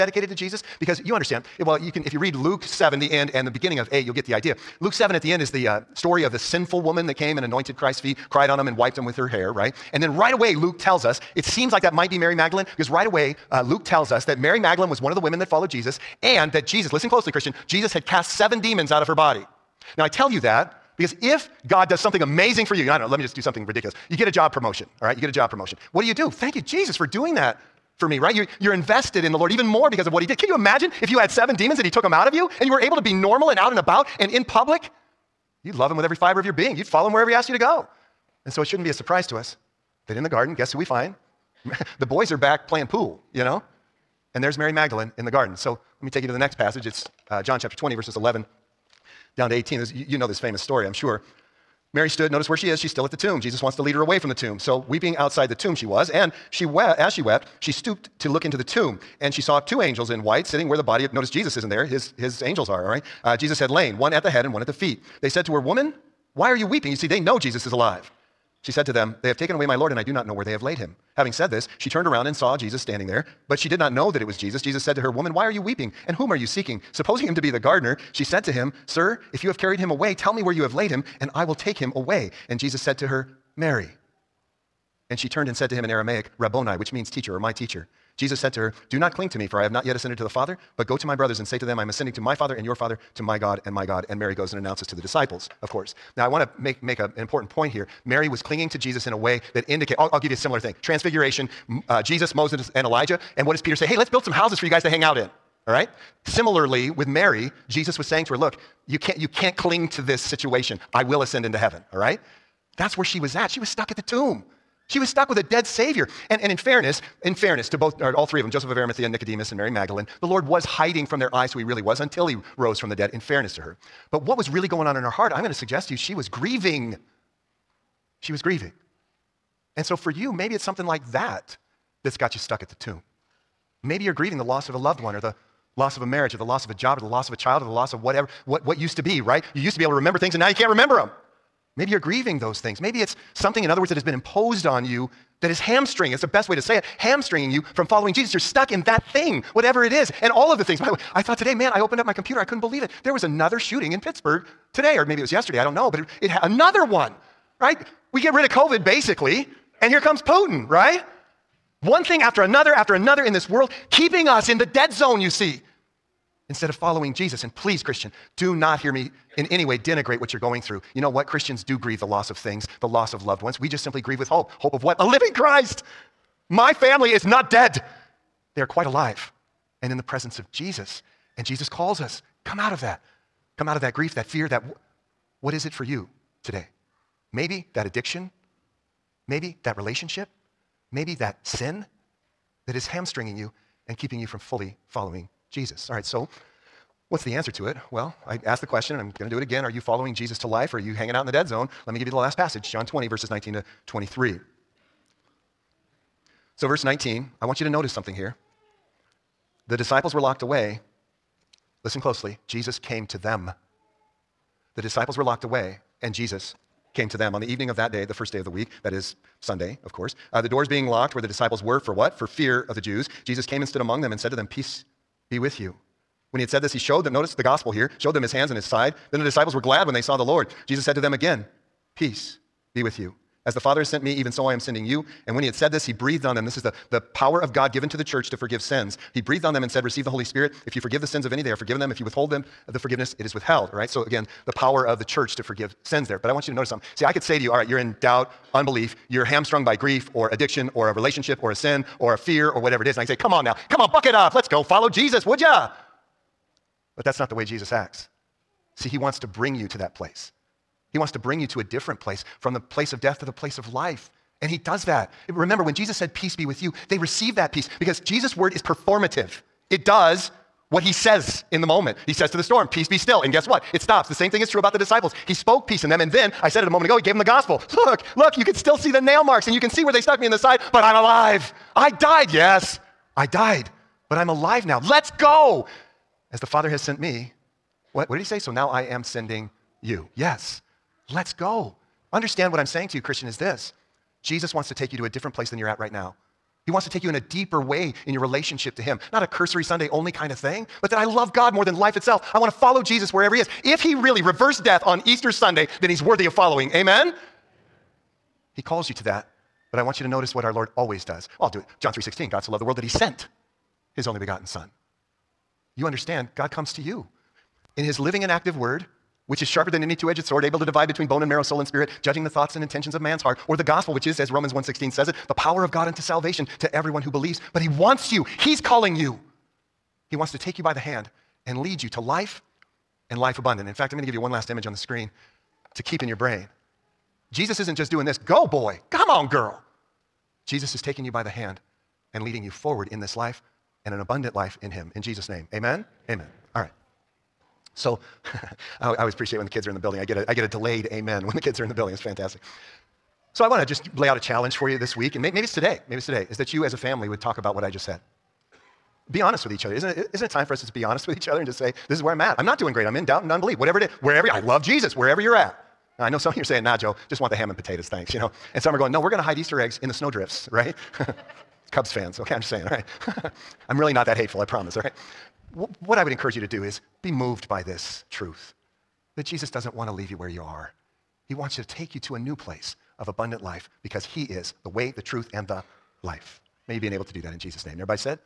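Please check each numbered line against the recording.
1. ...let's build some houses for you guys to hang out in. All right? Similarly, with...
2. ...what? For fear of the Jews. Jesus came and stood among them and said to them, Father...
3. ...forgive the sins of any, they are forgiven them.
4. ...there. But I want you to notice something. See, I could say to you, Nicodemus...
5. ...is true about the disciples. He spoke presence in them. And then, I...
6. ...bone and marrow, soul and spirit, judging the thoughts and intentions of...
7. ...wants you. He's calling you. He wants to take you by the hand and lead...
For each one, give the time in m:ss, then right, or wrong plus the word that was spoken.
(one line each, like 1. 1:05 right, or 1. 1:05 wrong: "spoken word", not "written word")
1. 1:43 right
2. 3:41 wrong: "Peace", not "Father"
3. 4:00 right
4. 4:06 wrong: "All", not "Nicodemus"
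5. 4:34 wrong: "peace", not "presence"
6. 5:21 right
7. 5:27 right.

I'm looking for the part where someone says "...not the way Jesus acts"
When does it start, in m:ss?
4:17.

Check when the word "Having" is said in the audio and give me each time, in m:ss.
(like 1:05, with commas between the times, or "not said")
1:11.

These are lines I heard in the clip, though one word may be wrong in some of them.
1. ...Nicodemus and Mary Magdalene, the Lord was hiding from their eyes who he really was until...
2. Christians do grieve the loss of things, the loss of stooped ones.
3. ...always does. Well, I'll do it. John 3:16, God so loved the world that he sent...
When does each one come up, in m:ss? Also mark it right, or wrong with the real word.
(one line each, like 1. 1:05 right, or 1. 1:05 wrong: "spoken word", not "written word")
1. 1:59 right
2. 2:51 wrong: "loved", not "stooped"
3. 5:10 right.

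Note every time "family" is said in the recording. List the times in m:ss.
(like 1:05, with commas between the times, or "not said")
2:56, 5:56.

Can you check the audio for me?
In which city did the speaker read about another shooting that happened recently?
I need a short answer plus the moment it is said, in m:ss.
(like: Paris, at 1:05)
Pittsburgh, at 2:34.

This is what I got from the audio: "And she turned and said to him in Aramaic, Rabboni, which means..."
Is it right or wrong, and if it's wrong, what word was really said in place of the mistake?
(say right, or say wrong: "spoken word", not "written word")
right.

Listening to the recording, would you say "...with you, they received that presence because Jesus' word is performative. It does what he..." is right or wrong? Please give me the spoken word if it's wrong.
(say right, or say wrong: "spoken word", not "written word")
wrong: "peace", not "presence".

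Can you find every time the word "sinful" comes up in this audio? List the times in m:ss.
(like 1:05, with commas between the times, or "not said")
0:06.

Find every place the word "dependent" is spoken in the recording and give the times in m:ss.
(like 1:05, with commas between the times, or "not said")
not said.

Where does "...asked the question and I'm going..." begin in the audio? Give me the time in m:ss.
3:18.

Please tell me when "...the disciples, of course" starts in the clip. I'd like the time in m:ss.
1:34.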